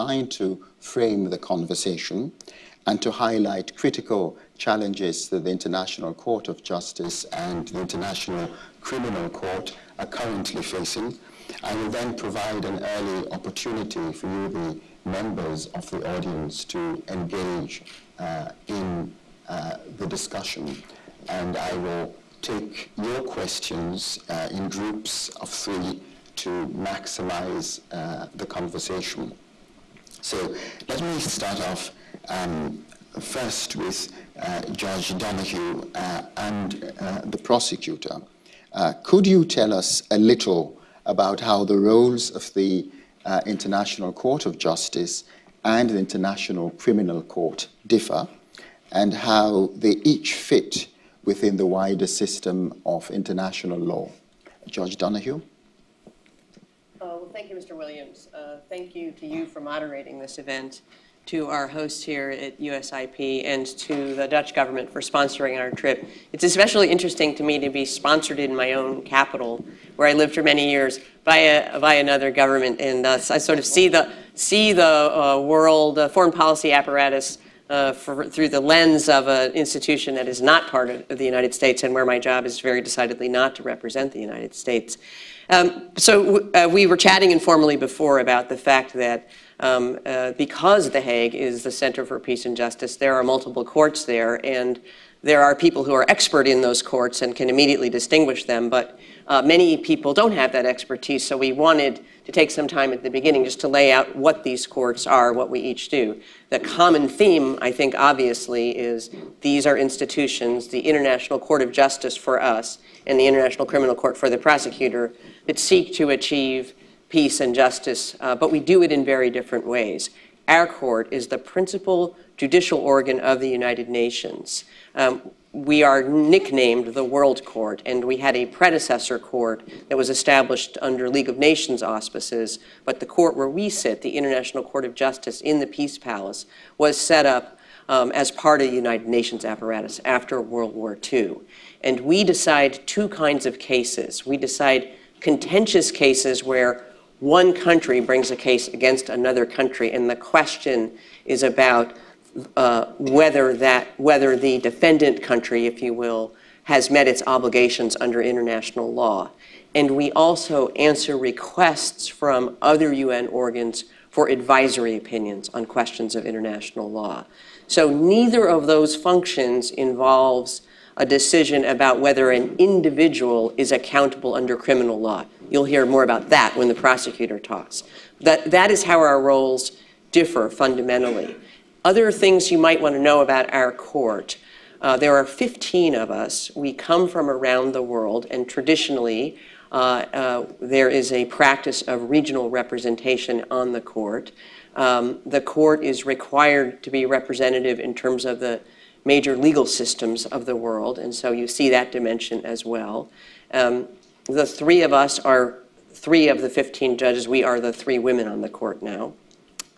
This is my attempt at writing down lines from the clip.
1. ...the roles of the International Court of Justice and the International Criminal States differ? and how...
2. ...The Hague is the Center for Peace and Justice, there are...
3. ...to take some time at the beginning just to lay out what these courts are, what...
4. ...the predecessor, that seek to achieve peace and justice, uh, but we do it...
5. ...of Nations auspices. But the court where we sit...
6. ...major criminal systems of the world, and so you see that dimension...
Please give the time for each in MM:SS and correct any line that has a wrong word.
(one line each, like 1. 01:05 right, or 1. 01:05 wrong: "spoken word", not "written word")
1. 00:41 wrong: "Court", not "States"
2. 01:30 right
3. 01:42 right
4. 01:54 wrong: "prosecutor", not "predecessor"
5. 02:11 right
6. 03:19 wrong: "legal", not "criminal".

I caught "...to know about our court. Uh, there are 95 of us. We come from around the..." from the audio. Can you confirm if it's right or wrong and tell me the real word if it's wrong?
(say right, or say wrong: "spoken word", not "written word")
wrong: "15", not "95".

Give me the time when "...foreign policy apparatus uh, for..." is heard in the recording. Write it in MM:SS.
01:16.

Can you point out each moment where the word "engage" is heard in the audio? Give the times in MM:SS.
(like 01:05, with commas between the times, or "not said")
00:17.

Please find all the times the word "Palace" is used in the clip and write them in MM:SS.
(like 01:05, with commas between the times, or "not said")
02:15.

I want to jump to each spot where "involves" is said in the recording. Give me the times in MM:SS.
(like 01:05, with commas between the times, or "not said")
02:49.